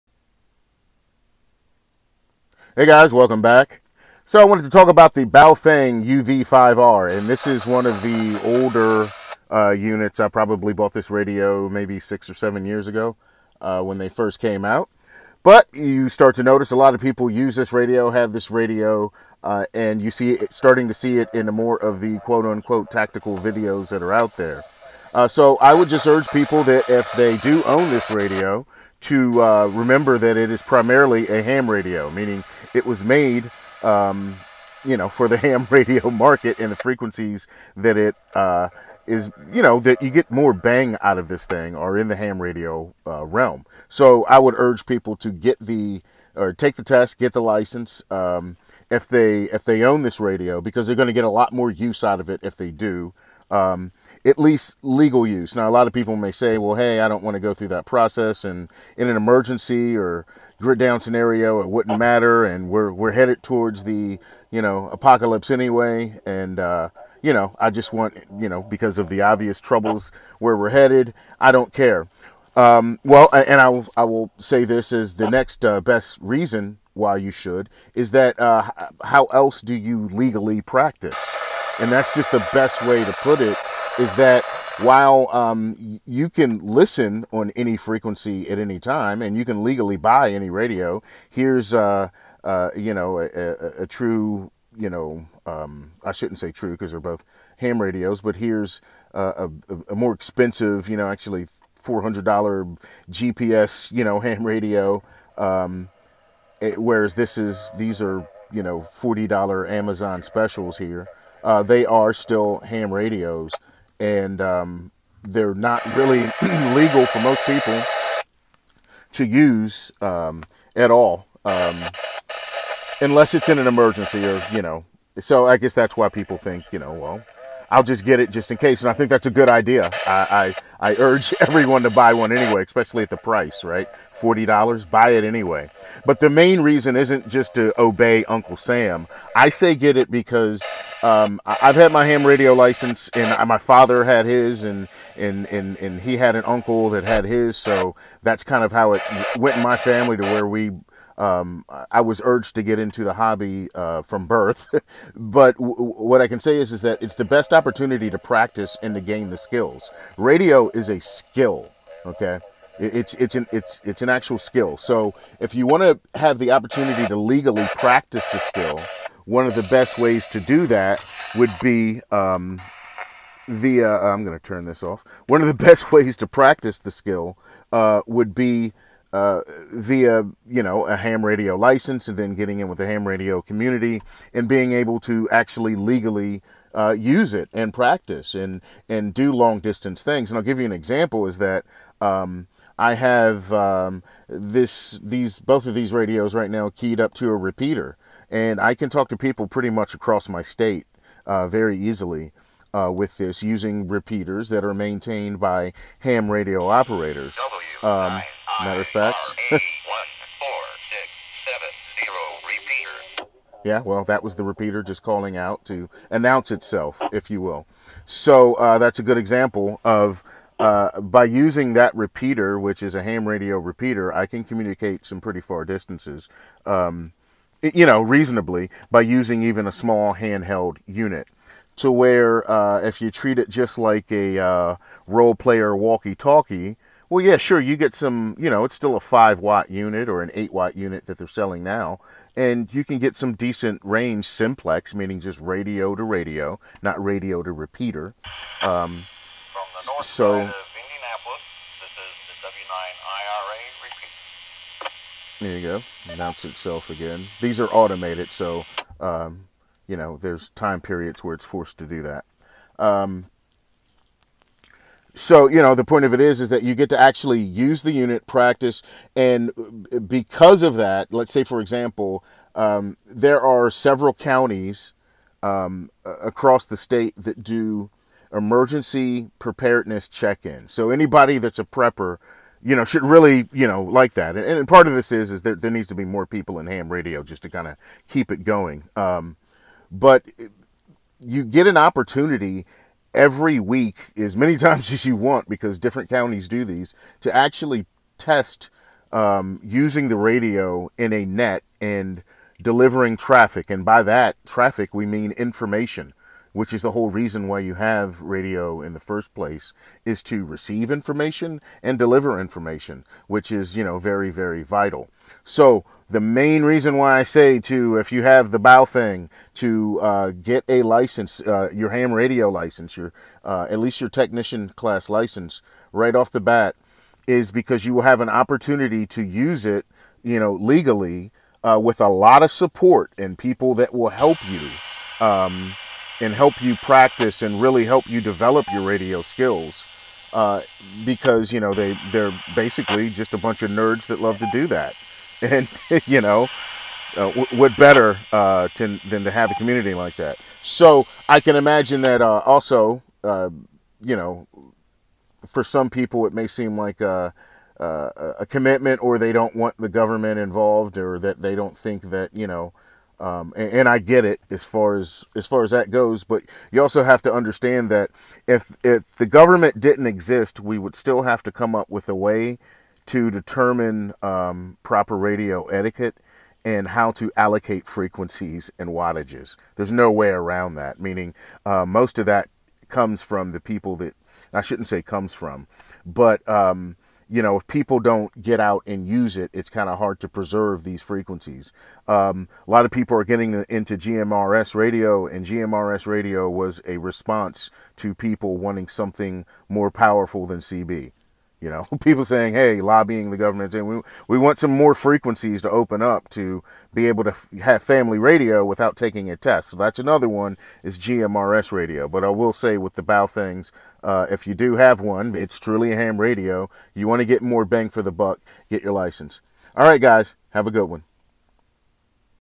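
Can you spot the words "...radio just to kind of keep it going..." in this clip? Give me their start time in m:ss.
4:46.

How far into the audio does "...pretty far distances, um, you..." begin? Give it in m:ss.
3:45.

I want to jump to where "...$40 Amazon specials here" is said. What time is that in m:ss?
1:48.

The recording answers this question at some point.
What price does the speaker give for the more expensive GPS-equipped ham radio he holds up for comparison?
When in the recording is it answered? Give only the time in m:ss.
1:41.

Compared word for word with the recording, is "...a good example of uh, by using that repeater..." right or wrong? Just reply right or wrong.
right.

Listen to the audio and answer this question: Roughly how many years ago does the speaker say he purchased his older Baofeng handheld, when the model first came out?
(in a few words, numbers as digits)
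6 or 7 years.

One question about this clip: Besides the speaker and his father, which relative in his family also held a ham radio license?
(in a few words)
an uncle.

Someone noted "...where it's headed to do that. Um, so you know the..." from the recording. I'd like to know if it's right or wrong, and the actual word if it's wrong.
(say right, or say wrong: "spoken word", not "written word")
wrong: "forced", not "headed".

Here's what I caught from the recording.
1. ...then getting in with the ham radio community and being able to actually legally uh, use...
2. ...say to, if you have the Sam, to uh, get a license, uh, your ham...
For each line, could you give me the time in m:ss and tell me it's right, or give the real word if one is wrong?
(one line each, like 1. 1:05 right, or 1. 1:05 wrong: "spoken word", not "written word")
1. 3:02 right
2. 5:17 wrong: "Baofeng", not "Sam".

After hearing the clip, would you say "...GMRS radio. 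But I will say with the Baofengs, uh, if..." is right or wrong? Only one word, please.
right.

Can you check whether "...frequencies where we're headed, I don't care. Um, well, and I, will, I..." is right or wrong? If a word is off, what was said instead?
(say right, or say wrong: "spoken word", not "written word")
wrong: "troubles", not "frequencies".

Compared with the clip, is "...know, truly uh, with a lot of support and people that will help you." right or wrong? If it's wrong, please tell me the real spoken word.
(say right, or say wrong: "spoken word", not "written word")
wrong: "legally", not "truly".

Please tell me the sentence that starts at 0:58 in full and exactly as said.
And in an emergency or grid down scenario, it wouldn't matter.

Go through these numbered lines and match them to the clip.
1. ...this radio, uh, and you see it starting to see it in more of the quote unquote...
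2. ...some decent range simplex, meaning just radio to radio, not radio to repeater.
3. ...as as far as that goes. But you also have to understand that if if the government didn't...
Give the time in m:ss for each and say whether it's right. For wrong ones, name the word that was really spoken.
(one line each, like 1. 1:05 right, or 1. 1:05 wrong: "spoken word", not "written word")
1. 0:18 right
2. 4:03 right
3. 6:04 right.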